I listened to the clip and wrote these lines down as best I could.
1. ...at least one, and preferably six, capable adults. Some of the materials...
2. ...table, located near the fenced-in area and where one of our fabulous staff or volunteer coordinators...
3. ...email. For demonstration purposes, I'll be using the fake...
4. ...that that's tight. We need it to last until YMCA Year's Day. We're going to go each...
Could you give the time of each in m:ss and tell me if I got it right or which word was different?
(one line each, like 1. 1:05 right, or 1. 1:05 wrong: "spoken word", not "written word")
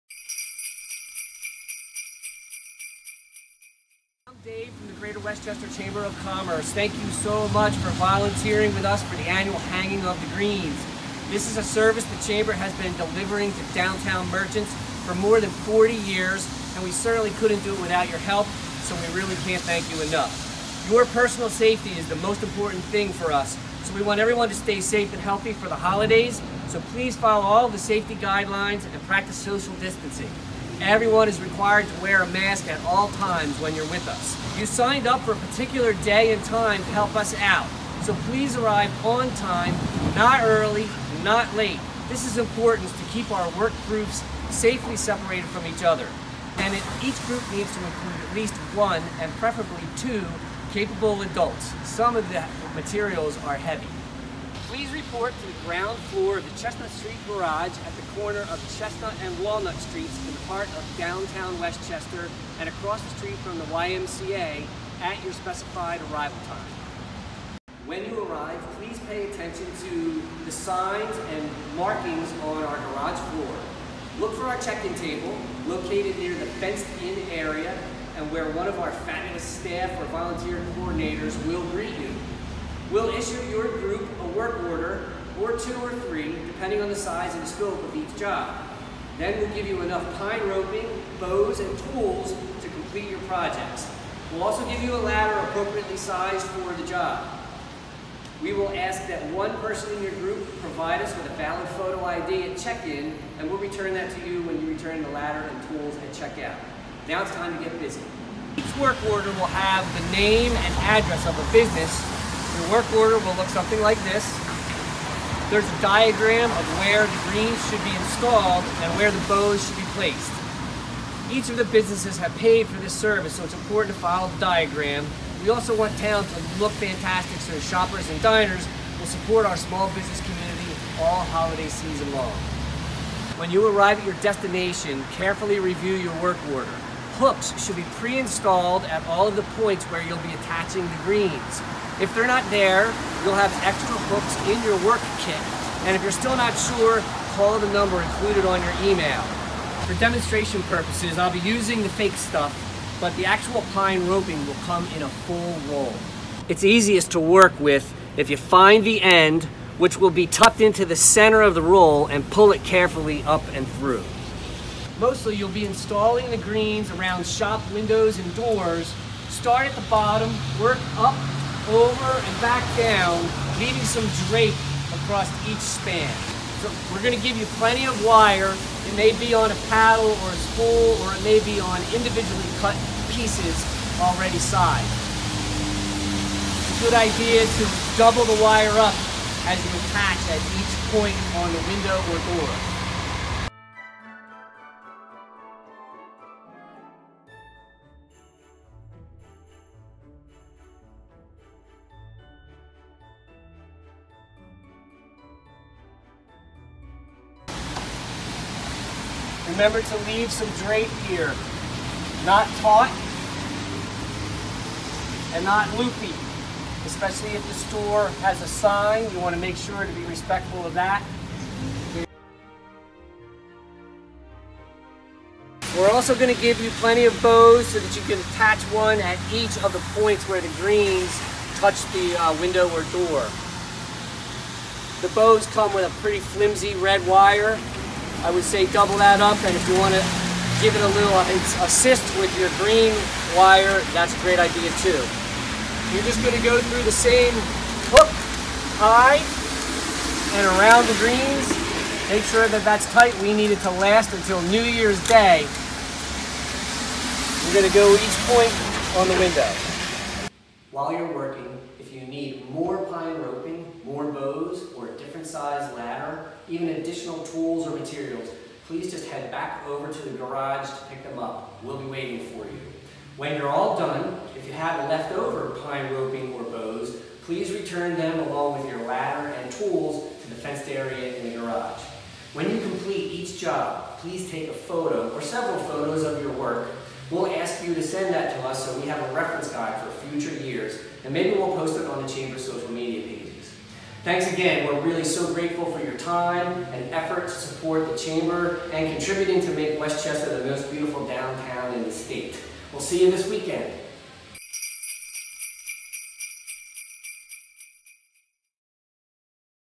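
1. 0:48 wrong: "two", not "six"
2. 1:14 right
3. 2:28 right
4. 4:12 wrong: "New", not "YMCA".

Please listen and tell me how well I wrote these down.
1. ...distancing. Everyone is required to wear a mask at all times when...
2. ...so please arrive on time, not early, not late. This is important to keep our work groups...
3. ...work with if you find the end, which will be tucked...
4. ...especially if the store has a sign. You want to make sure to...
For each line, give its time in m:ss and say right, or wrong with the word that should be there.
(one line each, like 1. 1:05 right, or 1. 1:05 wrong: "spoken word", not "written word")
1. 0:29 right
2. 0:38 right
3. 2:37 right
4. 3:36 right.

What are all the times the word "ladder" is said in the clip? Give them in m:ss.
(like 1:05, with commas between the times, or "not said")
1:34, 1:45, 4:25, 4:38.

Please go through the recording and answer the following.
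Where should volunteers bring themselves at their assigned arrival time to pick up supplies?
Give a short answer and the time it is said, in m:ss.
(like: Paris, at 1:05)
Chestnut Street Garage, at 0:56.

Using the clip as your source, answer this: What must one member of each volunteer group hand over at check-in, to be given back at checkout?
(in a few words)
valid photo ID.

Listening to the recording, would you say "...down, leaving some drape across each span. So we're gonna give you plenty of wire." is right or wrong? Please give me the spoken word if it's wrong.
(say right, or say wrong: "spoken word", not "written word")
right.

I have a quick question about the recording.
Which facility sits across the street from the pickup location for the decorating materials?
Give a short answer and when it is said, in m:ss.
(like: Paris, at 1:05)
YMCA, at 1:03.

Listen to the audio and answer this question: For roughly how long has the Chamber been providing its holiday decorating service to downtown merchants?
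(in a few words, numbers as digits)
more than 40 years.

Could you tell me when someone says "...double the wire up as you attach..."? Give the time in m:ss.
3:07.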